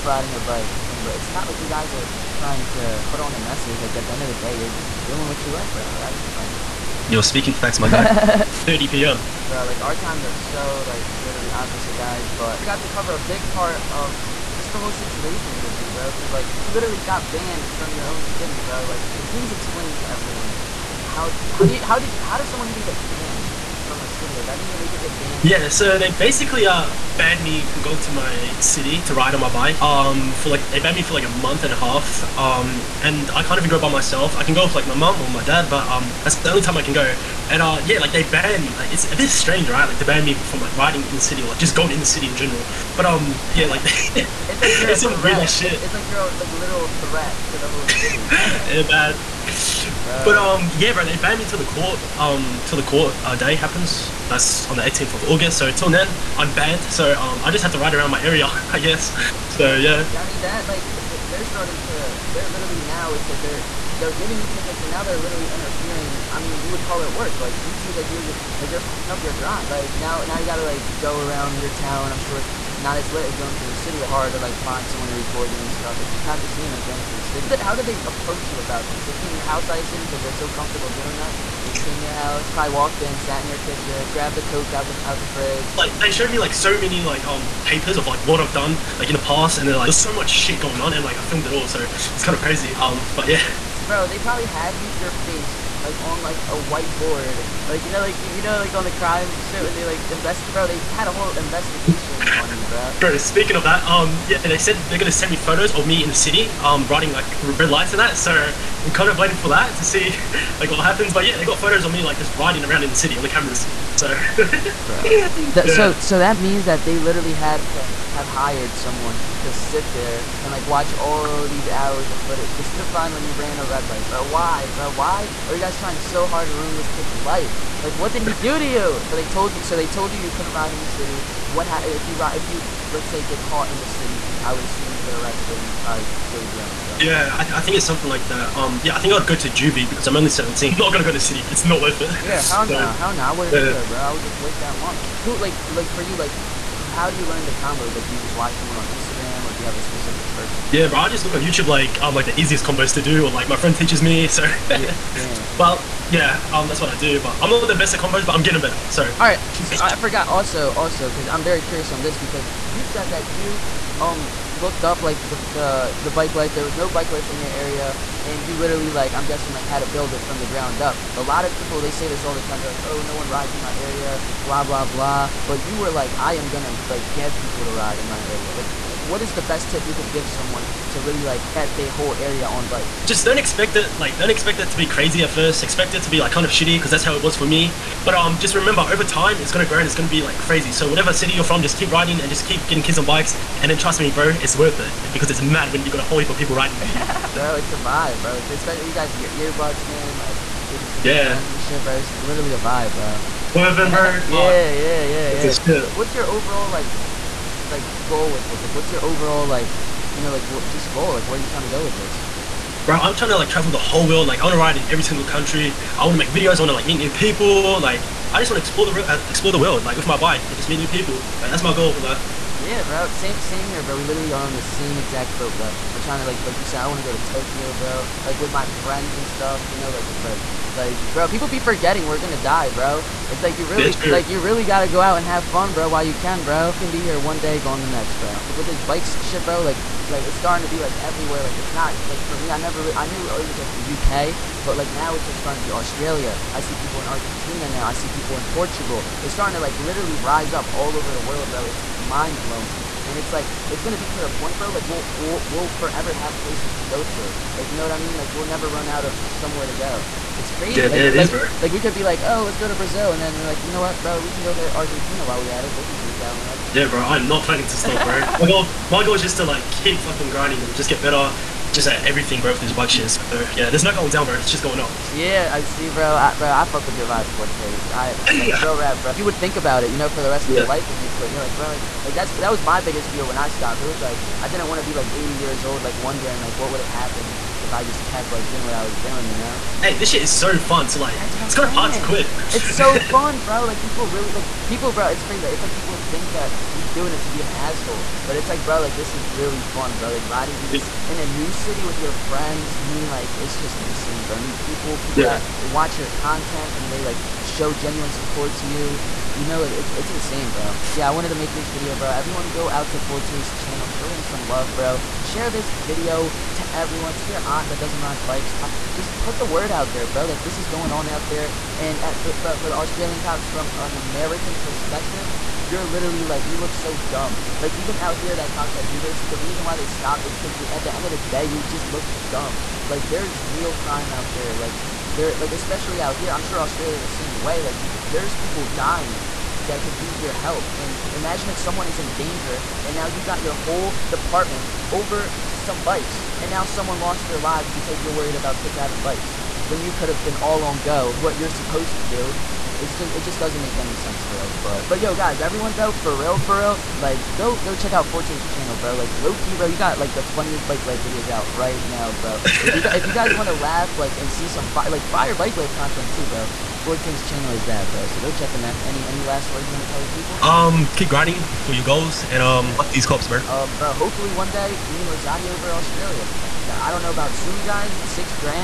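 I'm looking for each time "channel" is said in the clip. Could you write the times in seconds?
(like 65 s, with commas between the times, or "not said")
313 s, 358 s, 367 s.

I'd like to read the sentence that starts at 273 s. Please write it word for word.
So, yeah, there's not going down, bro.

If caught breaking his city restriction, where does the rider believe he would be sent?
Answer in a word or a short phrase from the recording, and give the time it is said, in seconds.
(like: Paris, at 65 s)
juvie, at 139 s.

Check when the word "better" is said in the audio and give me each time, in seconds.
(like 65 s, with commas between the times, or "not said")
158 s, 271 s.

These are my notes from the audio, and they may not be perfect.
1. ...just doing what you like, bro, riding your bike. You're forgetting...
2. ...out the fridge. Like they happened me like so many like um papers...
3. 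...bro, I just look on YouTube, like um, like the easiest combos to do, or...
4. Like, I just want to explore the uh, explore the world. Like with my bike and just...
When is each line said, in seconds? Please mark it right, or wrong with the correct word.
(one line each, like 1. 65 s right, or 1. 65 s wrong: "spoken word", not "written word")
1. 4 s wrong: "speaking", not "forgetting"
2. 85 s wrong: "showed", not "happened"
3. 150 s right
4. 217 s right.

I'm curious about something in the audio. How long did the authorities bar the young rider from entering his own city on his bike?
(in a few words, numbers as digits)
a month and a half.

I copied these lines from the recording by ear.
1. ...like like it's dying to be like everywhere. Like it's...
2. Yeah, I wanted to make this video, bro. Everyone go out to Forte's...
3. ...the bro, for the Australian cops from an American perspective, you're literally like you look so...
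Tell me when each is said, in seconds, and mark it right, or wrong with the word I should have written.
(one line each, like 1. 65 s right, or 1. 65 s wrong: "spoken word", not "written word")
1. 239 s wrong: "starting", not "dying"
2. 310 s right
3. 322 s right.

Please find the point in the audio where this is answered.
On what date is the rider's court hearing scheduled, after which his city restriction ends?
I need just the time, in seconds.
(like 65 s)
54 s.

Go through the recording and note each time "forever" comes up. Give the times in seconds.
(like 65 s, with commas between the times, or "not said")
255 s.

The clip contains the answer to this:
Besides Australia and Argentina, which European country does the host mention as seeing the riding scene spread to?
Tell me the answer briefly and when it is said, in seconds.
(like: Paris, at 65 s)
Portugal, at 248 s.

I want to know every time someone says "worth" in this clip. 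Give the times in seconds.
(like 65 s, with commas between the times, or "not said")
141 s, 194 s.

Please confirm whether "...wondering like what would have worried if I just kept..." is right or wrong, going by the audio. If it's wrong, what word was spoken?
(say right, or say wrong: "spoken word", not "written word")
wrong: "happened", not "worried".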